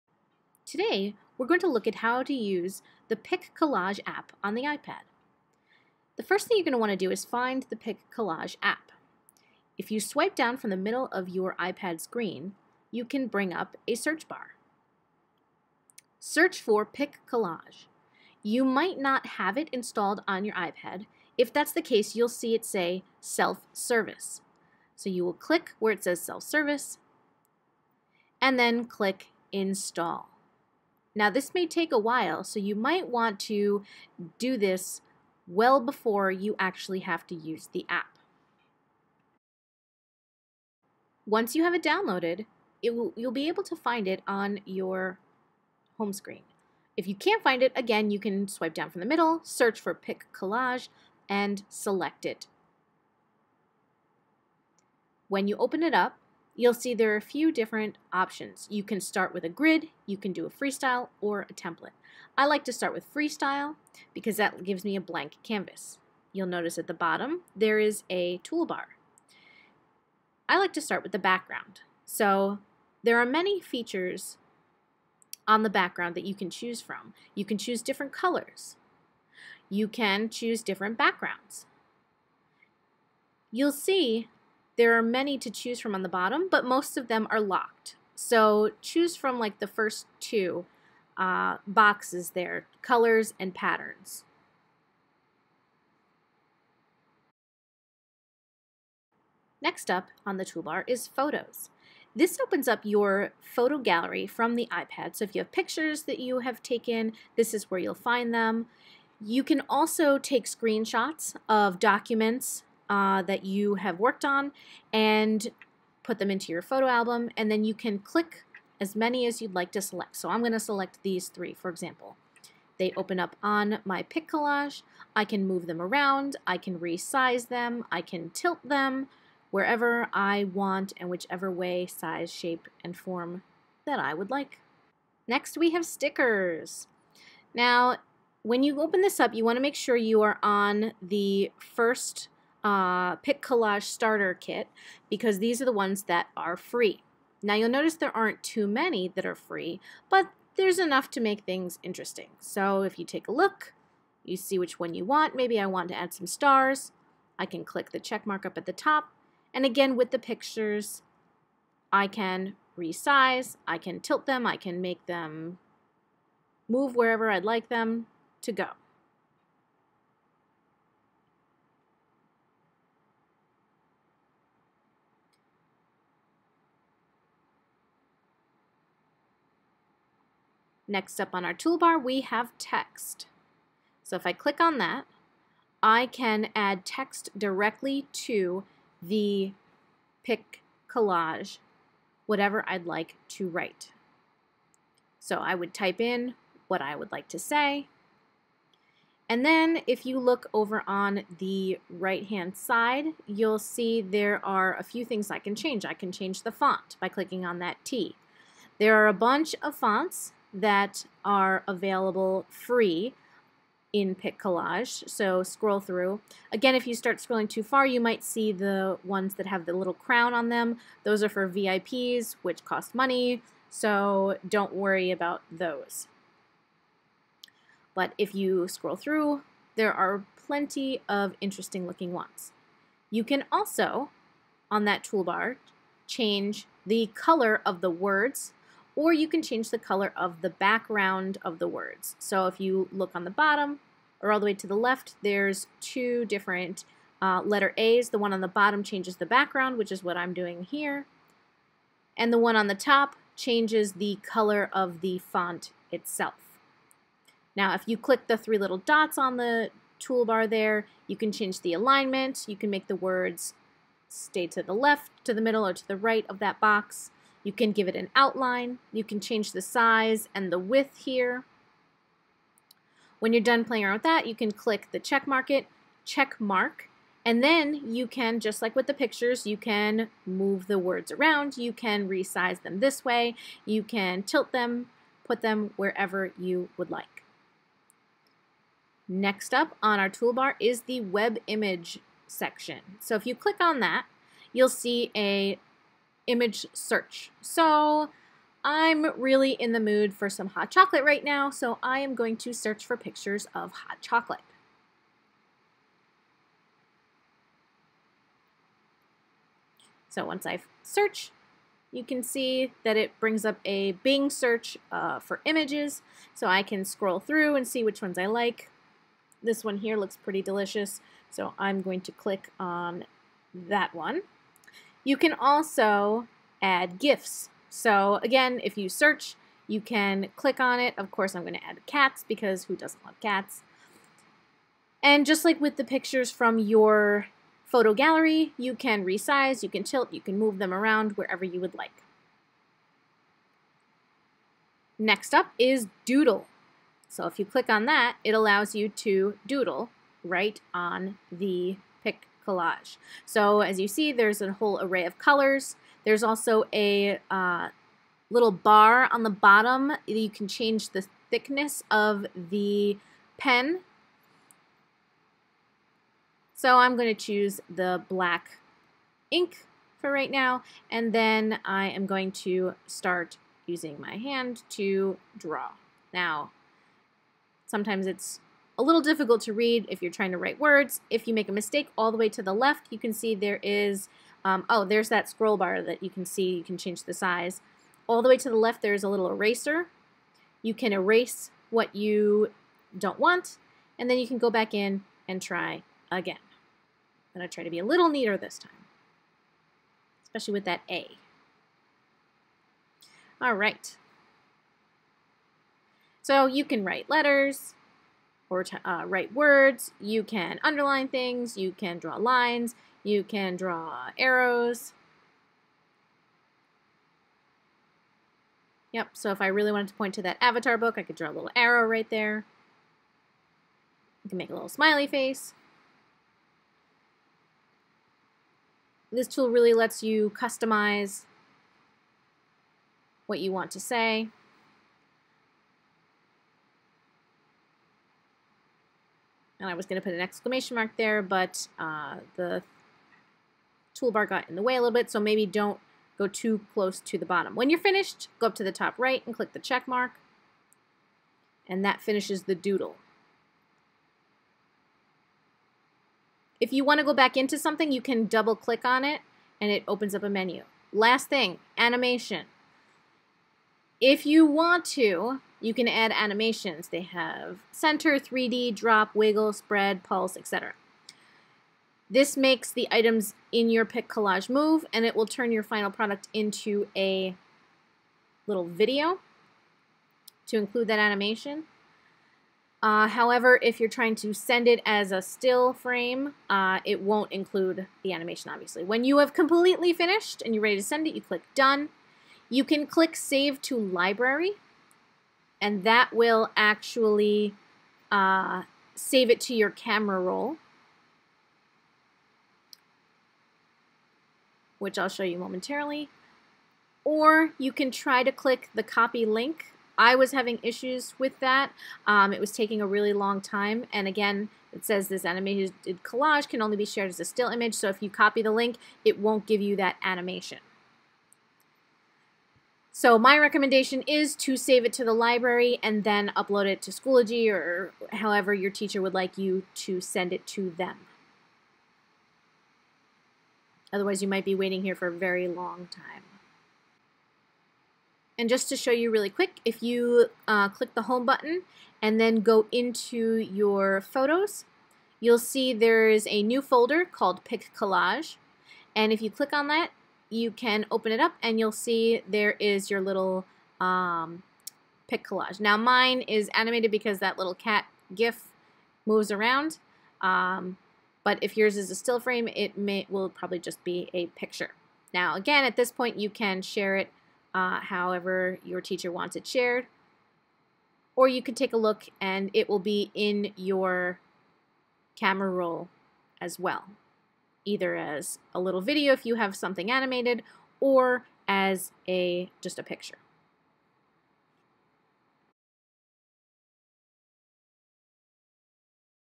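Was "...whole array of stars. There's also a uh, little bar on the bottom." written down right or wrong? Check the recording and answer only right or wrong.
wrong.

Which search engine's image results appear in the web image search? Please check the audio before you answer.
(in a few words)
Bing.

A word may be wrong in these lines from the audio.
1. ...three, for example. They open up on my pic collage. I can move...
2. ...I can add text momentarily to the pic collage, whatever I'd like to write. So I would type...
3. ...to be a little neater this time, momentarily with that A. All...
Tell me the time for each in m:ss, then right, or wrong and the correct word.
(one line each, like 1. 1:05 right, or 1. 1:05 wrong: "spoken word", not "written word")
1. 2:01 right
2. 3:05 wrong: "directly", not "momentarily"
3. 6:37 wrong: "especially", not "momentarily".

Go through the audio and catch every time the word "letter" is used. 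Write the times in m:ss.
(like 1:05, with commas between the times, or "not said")
4:07, 6:47.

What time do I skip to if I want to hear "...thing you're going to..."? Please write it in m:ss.
0:06.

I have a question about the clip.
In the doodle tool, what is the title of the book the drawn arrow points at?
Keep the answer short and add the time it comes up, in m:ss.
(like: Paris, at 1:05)
Avatar, at 7:00.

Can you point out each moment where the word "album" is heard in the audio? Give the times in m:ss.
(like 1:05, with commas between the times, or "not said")
1:56.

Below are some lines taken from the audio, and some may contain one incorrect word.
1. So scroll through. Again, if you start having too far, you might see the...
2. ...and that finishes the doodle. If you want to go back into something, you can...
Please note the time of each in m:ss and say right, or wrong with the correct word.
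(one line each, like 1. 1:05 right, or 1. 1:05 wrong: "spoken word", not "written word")
1. 3:35 wrong: "scrolling", not "having"
2. 7:31 right.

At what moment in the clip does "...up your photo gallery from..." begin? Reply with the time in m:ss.
1:42.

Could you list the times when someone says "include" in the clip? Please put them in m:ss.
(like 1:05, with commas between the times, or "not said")
8:00, 8:07.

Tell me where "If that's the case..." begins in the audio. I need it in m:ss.
0:21.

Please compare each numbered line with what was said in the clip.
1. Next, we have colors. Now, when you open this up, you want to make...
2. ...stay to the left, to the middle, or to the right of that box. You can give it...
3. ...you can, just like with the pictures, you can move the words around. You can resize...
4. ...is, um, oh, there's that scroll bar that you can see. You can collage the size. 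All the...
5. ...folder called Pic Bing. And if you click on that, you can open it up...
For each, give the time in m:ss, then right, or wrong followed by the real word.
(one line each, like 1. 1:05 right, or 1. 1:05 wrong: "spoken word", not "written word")
1. 2:15 wrong: "stickers", not "colors"
2. 4:24 right
3. 4:37 right
4. 6:23 wrong: "change", not "collage"
5. 9:06 wrong: "Collage", not "Bing".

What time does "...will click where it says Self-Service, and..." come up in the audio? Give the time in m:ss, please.
0:25.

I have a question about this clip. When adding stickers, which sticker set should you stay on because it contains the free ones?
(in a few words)
Pic Collage Starter Kit.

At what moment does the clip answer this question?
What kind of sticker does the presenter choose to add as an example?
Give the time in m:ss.
2:36.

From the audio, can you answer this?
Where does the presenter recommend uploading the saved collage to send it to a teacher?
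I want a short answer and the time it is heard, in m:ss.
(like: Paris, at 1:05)
Schoology, at 8:46.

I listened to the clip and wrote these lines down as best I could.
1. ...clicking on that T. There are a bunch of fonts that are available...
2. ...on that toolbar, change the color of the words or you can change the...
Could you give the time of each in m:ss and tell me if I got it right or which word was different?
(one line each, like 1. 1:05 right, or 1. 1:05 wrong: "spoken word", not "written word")
1. 3:27 right
2. 3:54 right.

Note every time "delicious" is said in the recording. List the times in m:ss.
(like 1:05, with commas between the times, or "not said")
5:20.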